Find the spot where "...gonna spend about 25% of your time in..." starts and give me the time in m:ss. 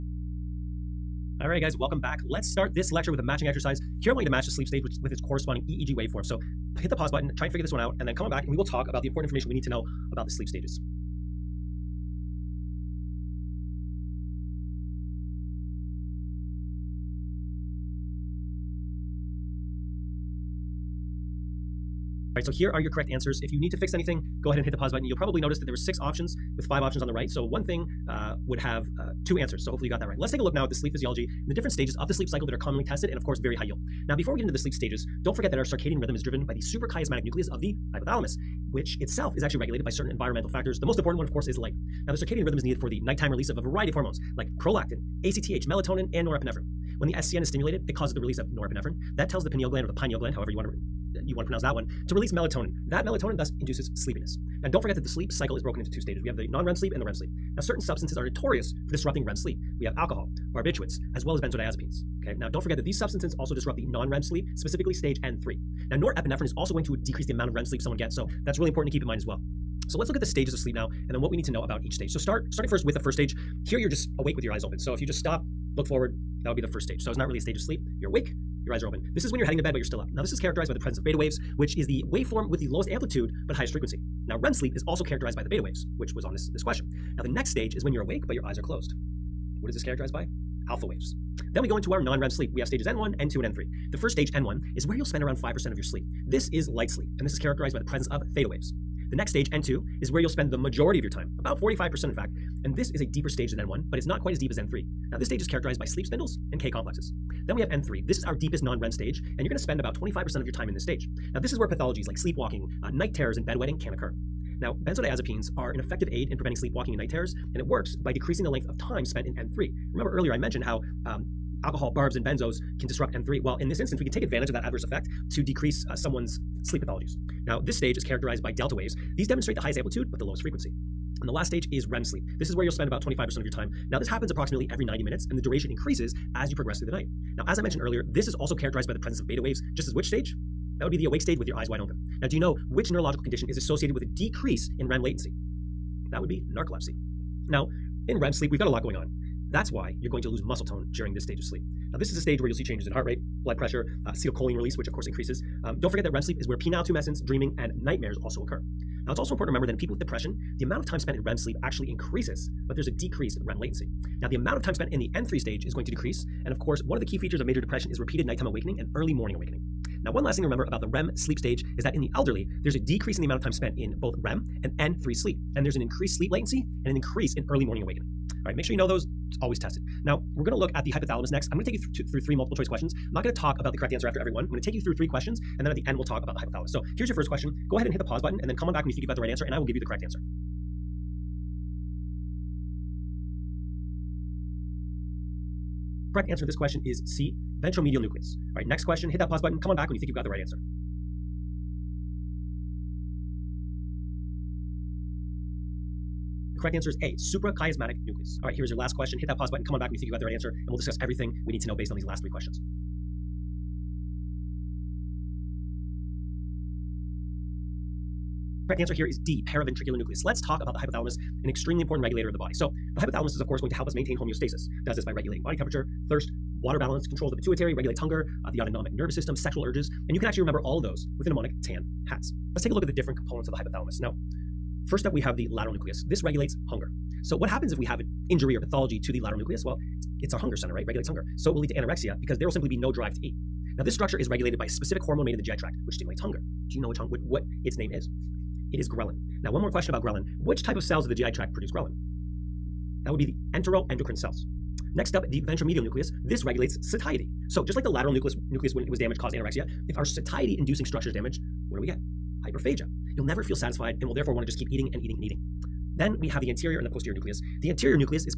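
1:49.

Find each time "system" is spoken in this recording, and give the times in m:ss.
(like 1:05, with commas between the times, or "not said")
3:49.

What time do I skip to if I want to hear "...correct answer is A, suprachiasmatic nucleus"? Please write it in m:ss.
3:26.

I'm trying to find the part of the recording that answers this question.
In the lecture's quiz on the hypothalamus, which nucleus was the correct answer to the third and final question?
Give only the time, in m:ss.
3:39.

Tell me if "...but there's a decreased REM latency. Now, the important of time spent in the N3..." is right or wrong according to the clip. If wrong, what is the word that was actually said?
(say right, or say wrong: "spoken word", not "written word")
wrong: "amount", not "important".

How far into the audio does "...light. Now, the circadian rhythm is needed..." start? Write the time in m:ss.
0:41.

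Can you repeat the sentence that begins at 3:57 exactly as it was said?
So what happens if we have an injury or pathology to the lateral nucleus?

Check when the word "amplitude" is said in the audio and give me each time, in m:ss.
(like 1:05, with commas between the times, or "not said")
1:22, 2:09.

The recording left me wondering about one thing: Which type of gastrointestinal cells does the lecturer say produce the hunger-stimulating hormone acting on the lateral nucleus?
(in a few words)
Enteroendocrine cells.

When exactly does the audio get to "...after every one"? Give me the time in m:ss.
3:04.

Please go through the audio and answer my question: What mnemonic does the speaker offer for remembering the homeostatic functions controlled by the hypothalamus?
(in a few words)
TAN hats.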